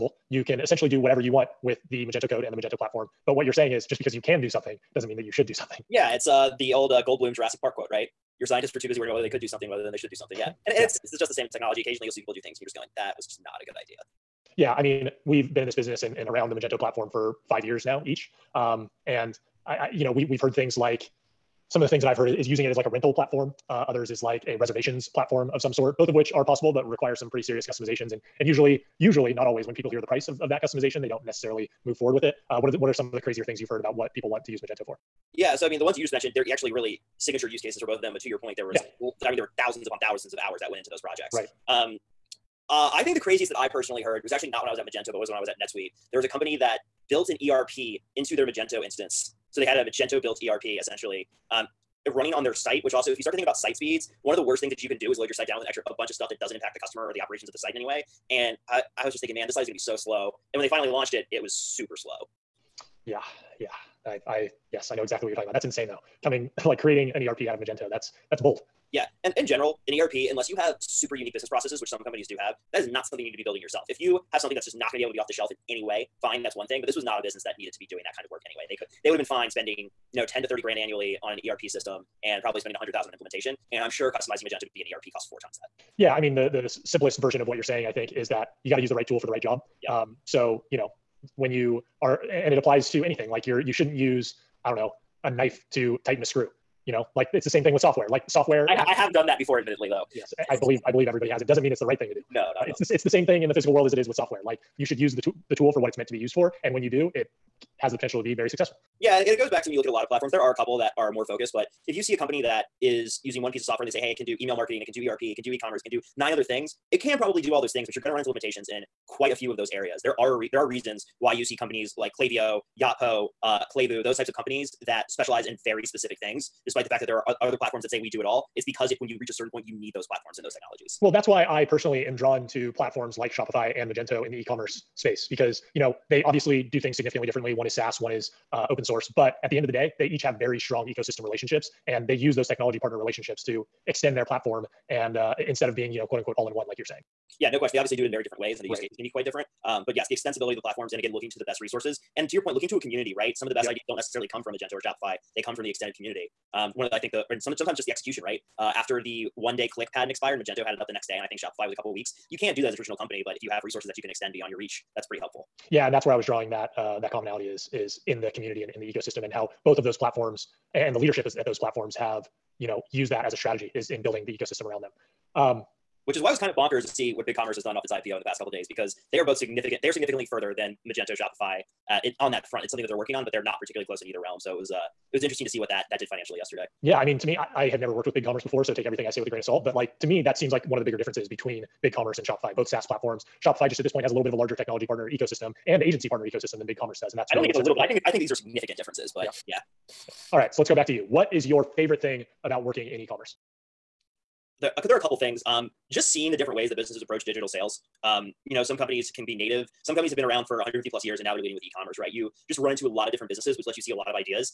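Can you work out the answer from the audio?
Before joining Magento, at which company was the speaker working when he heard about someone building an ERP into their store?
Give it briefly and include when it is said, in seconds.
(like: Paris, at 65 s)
NetSuite, at 45 s.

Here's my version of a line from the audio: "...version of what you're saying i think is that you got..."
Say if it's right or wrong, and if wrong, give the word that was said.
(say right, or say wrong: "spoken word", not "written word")
right.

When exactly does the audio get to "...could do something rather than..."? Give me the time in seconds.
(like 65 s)
9 s.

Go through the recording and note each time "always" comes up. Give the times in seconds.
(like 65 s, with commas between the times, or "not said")
29 s.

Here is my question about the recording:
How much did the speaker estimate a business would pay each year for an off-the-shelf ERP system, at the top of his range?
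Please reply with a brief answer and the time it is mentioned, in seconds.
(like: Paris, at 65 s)
30 grand, at 80 s.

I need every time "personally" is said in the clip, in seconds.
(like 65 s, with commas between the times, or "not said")
43 s, 131 s.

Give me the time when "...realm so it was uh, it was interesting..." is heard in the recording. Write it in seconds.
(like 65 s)
184 s.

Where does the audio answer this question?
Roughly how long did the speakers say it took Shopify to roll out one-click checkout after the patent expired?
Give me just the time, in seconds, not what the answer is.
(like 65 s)
161 s.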